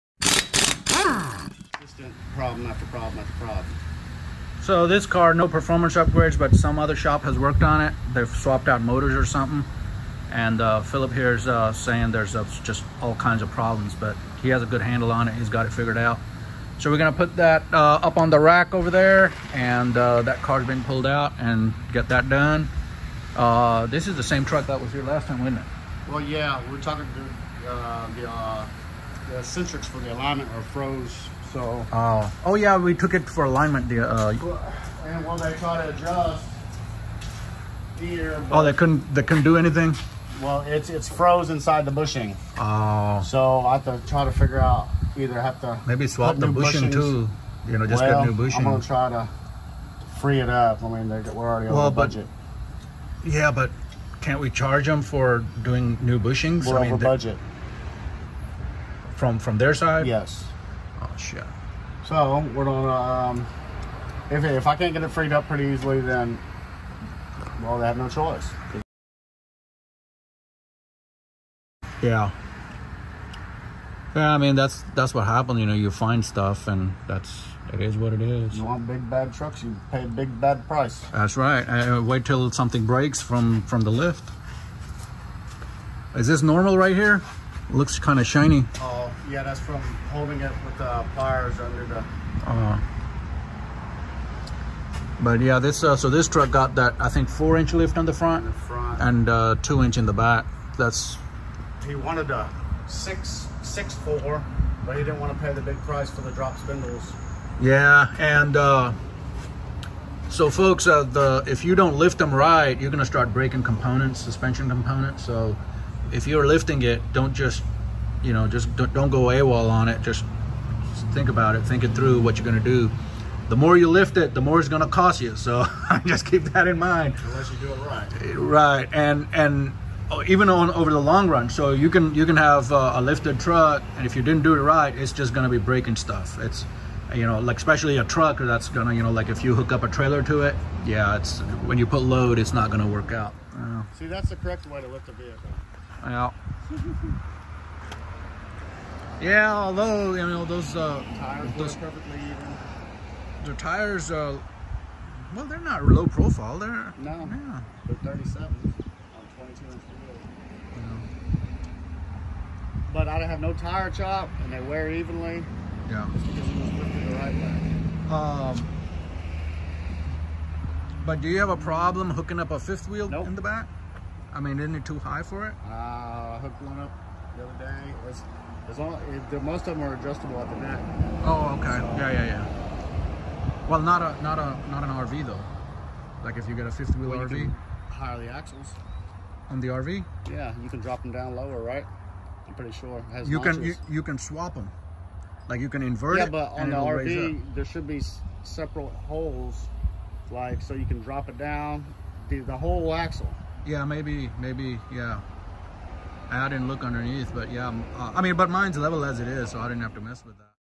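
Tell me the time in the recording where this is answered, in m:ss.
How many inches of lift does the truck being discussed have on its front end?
1:37.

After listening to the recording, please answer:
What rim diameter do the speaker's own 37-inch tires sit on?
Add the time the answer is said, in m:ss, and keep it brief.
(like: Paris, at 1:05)
22 inch, at 2:39.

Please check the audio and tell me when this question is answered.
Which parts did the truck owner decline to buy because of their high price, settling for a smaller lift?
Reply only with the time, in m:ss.
1:46.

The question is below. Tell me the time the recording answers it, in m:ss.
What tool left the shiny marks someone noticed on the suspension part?
1:31.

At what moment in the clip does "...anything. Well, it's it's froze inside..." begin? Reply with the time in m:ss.
0:39.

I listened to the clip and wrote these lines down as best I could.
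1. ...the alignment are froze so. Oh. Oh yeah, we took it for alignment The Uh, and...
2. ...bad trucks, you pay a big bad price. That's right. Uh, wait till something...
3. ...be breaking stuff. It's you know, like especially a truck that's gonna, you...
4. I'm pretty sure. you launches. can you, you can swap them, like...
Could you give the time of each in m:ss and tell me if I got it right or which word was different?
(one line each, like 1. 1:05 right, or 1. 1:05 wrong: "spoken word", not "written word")
1. 0:29 right
2. 1:19 right
3. 2:15 right
4. 3:12 right.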